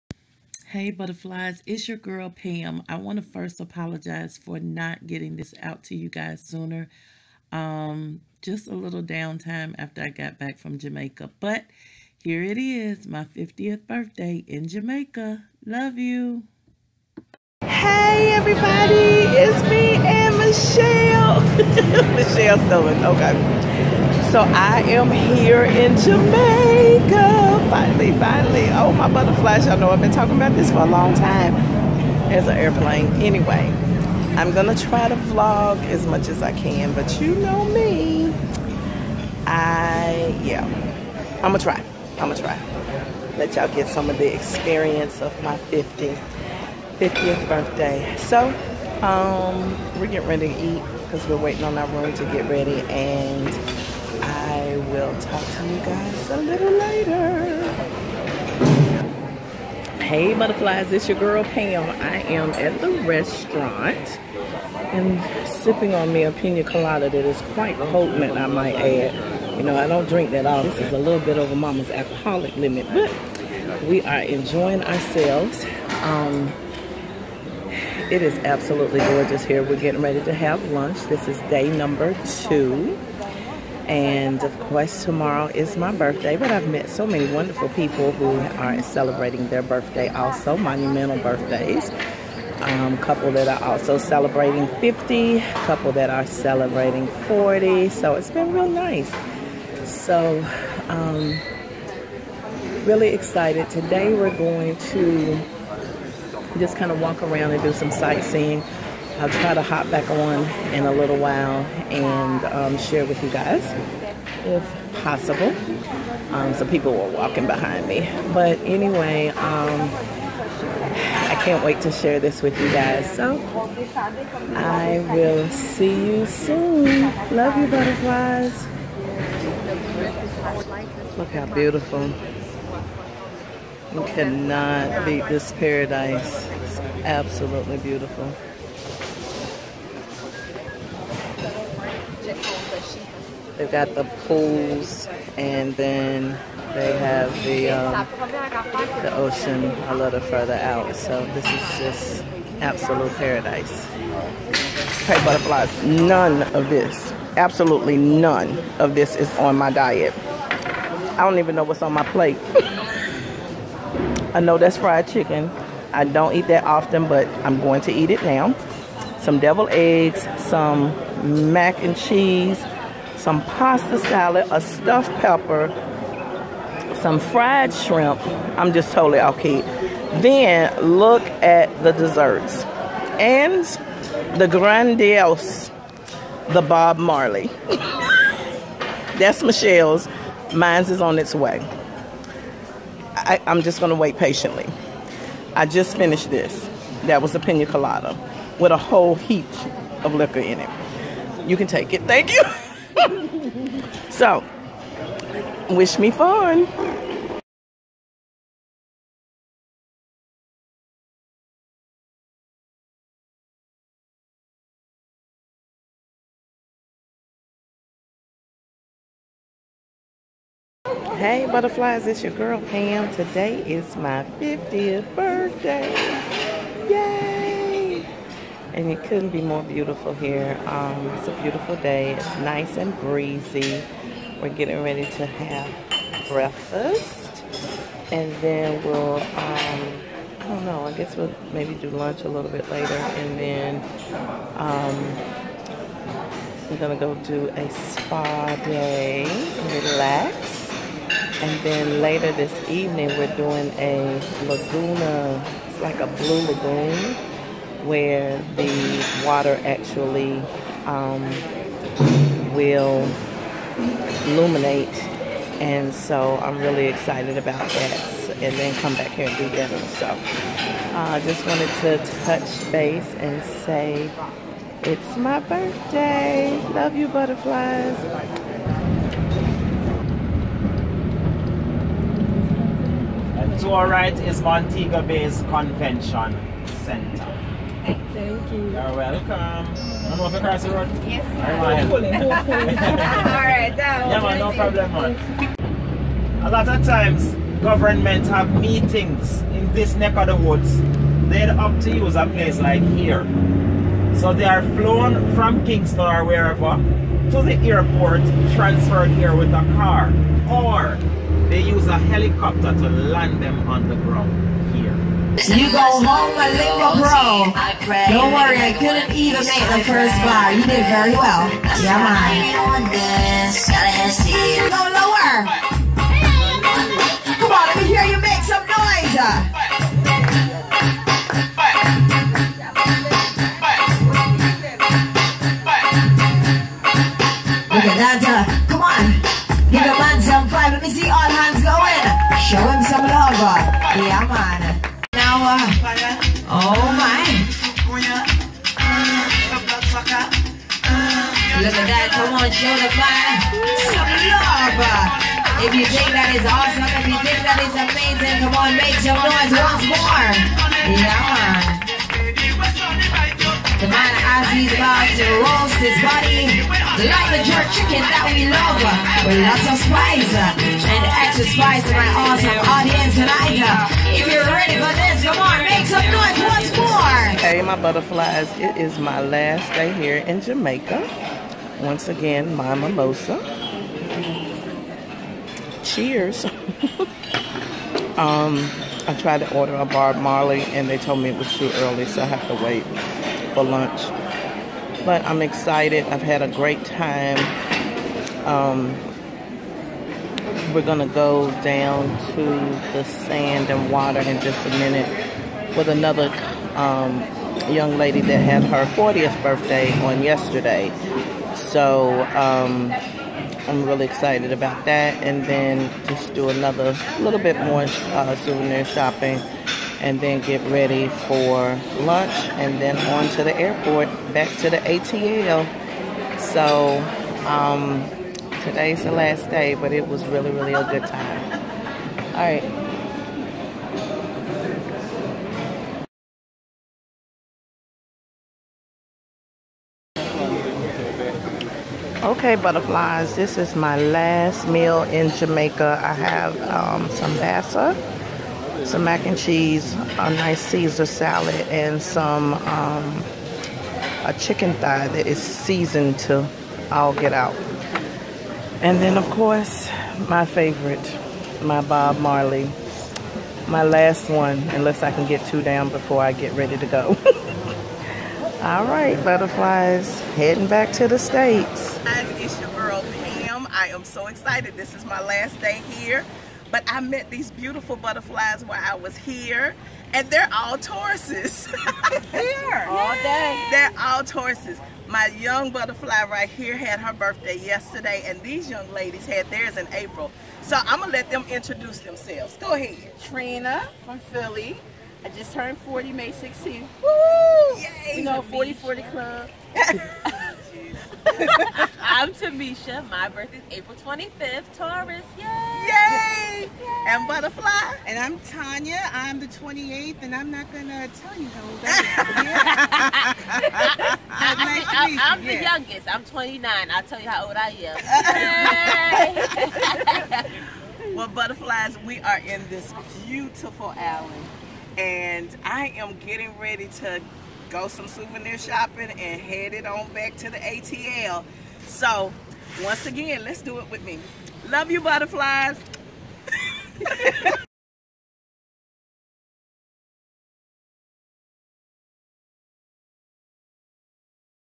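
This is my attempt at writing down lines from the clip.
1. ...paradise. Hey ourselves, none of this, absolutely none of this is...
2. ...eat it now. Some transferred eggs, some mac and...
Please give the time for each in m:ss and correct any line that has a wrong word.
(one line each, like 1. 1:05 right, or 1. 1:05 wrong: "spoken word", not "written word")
1. 2:33 wrong: "butterflies", not "ourselves"
2. 2:47 wrong: "deviled", not "transferred".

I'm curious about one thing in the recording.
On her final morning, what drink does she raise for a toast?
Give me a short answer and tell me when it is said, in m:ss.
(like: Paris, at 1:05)
Mimosa, at 6:22.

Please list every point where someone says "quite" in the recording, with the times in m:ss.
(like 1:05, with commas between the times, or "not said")
1:07.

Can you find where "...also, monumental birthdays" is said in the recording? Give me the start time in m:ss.
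1:30.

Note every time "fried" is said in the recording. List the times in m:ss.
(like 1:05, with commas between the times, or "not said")
2:44, 2:57.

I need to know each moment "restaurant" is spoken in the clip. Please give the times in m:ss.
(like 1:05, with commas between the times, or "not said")
1:03.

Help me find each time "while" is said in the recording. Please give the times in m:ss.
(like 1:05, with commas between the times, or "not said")
1:51, 7:58.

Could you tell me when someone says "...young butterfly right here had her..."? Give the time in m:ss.
8:05.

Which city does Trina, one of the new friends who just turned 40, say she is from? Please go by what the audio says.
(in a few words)
Philly.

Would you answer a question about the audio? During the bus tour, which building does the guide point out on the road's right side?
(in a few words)
Montego Bay's Convention Center.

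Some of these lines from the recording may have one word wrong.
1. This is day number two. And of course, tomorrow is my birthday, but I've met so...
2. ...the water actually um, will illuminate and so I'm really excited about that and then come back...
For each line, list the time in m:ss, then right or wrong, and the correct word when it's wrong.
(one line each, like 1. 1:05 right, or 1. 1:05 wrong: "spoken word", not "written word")
1. 1:21 right
2. 4:18 right.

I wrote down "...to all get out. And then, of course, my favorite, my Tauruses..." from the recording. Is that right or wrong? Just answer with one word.
wrong.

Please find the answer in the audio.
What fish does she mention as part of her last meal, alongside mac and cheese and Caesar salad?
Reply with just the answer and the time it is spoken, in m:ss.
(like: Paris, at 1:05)
Bassa, at 7:27.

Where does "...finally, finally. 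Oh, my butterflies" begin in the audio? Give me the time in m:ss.
0:27.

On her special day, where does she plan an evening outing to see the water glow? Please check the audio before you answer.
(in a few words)
Laguna.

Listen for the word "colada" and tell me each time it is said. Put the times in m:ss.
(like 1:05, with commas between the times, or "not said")
1:06, 3:17.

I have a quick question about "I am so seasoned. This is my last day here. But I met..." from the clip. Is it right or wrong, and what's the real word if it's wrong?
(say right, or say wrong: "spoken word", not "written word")
wrong: "excited", not "seasoned".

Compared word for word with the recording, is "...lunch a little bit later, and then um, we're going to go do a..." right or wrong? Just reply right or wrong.
right.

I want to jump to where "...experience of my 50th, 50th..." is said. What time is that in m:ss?
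0:44.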